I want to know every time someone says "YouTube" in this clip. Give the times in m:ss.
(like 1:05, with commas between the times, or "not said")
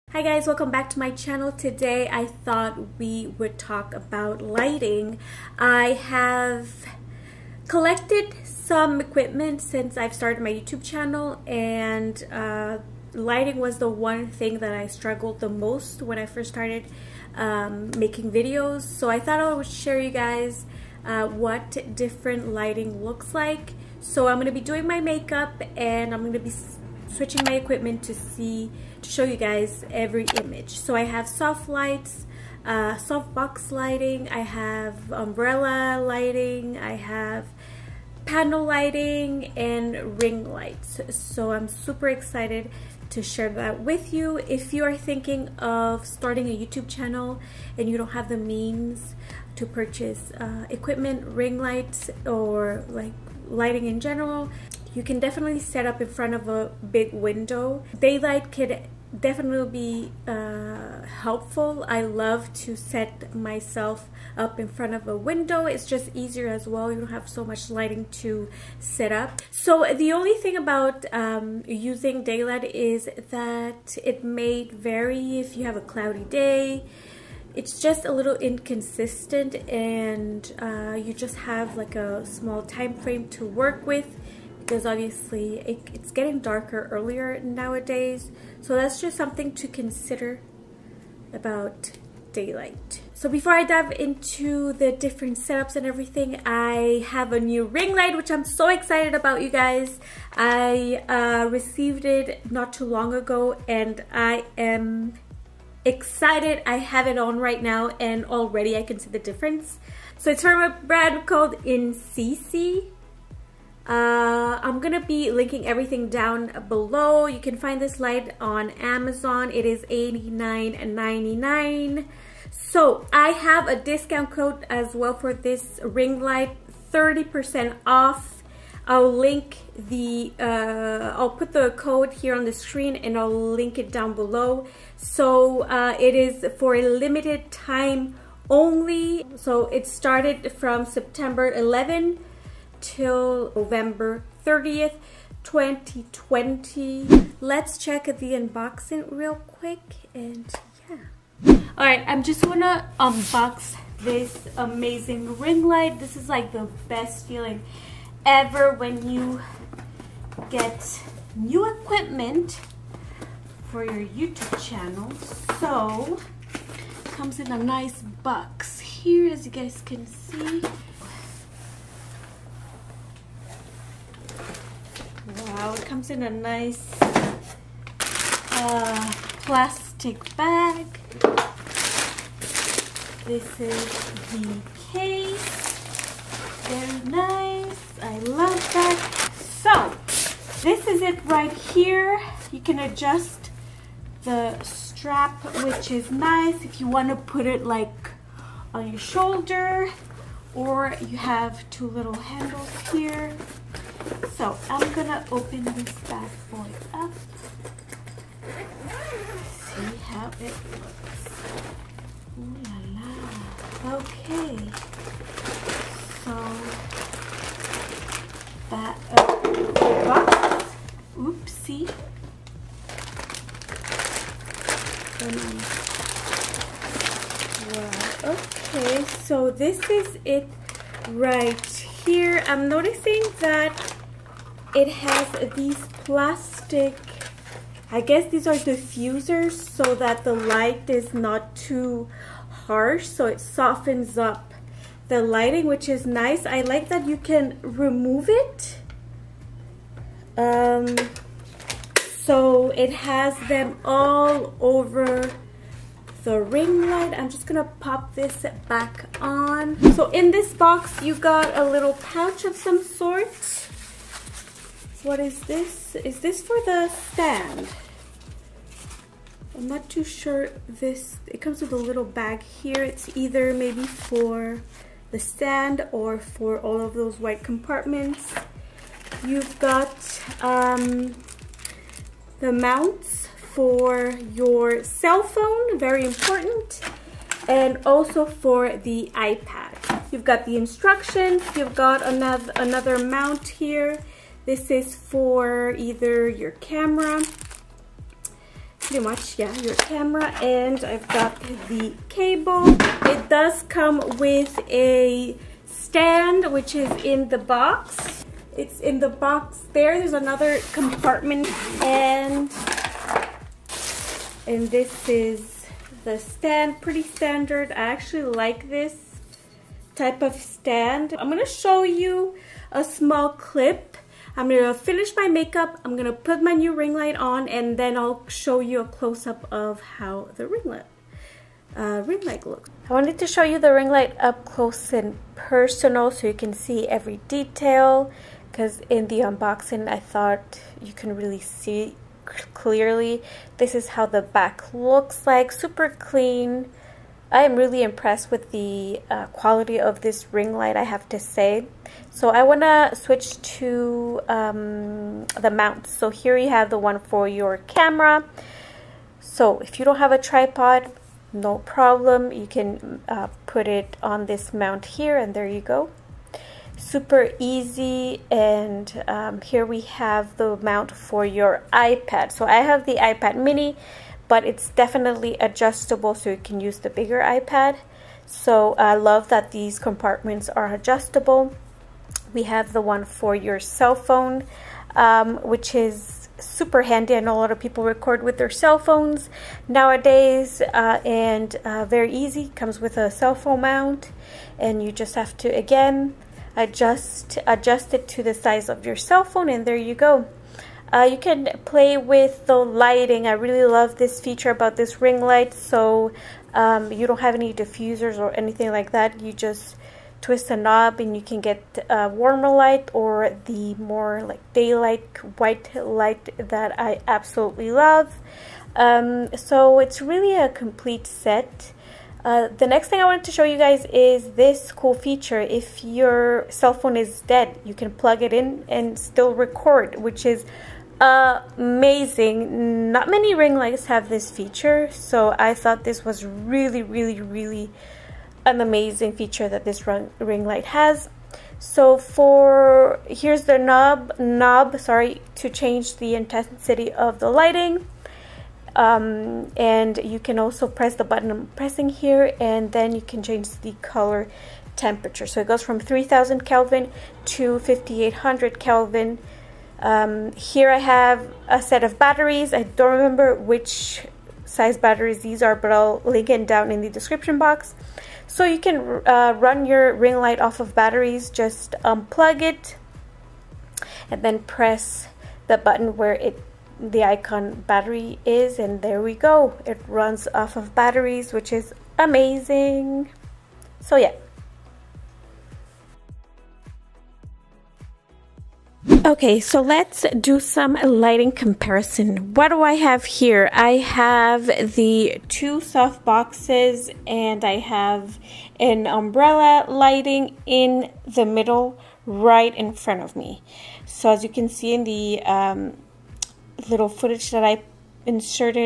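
0:10, 0:46, 2:44.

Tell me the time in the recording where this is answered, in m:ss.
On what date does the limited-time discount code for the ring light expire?
2:23.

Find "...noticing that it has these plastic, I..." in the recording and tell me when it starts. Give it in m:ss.
3:52.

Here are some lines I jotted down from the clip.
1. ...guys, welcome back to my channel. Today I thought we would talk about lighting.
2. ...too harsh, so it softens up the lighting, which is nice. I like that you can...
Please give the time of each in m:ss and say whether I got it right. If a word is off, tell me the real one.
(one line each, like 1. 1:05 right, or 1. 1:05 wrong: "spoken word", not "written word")
1. 0:00 right
2. 4:01 right.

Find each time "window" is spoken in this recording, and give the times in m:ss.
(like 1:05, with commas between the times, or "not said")
0:57, 1:05.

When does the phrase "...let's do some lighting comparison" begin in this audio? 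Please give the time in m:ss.
8:09.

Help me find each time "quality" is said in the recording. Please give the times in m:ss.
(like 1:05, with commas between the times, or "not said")
5:49.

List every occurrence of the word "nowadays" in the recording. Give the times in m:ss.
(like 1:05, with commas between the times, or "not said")
1:27, 6:29.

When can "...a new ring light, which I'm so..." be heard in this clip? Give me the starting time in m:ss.
1:37.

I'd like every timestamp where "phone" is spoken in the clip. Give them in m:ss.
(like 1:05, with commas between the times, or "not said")
4:45, 6:23, 6:28, 6:33, 6:39, 7:06.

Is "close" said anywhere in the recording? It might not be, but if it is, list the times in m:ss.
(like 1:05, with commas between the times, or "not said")
5:28, 5:34.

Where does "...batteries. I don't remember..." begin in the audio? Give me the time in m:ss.
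7:41.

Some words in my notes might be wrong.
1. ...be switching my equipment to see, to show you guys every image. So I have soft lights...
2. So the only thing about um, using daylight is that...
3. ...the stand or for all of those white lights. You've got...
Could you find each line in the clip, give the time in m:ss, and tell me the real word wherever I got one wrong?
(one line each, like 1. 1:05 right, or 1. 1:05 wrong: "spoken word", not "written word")
1. 0:26 right
2. 1:09 right
3. 4:35 wrong: "compartments", not "lights".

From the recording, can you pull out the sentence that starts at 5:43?
This is how the back looks like, super clean.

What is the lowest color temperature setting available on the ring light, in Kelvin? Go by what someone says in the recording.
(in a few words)
3000 Kelvin.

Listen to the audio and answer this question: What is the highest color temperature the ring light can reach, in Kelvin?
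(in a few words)
5800 Kelvin.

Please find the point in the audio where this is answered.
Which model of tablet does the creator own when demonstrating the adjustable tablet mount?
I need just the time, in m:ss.
6:12.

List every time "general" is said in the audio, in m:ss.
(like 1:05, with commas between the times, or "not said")
0:53.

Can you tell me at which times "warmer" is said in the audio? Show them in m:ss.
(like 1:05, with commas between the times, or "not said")
6:52.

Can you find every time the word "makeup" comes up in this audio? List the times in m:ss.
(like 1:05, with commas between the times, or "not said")
0:25, 5:25.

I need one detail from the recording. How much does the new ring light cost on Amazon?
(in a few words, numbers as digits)
$89.99.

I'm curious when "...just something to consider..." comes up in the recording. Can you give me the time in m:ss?
1:29.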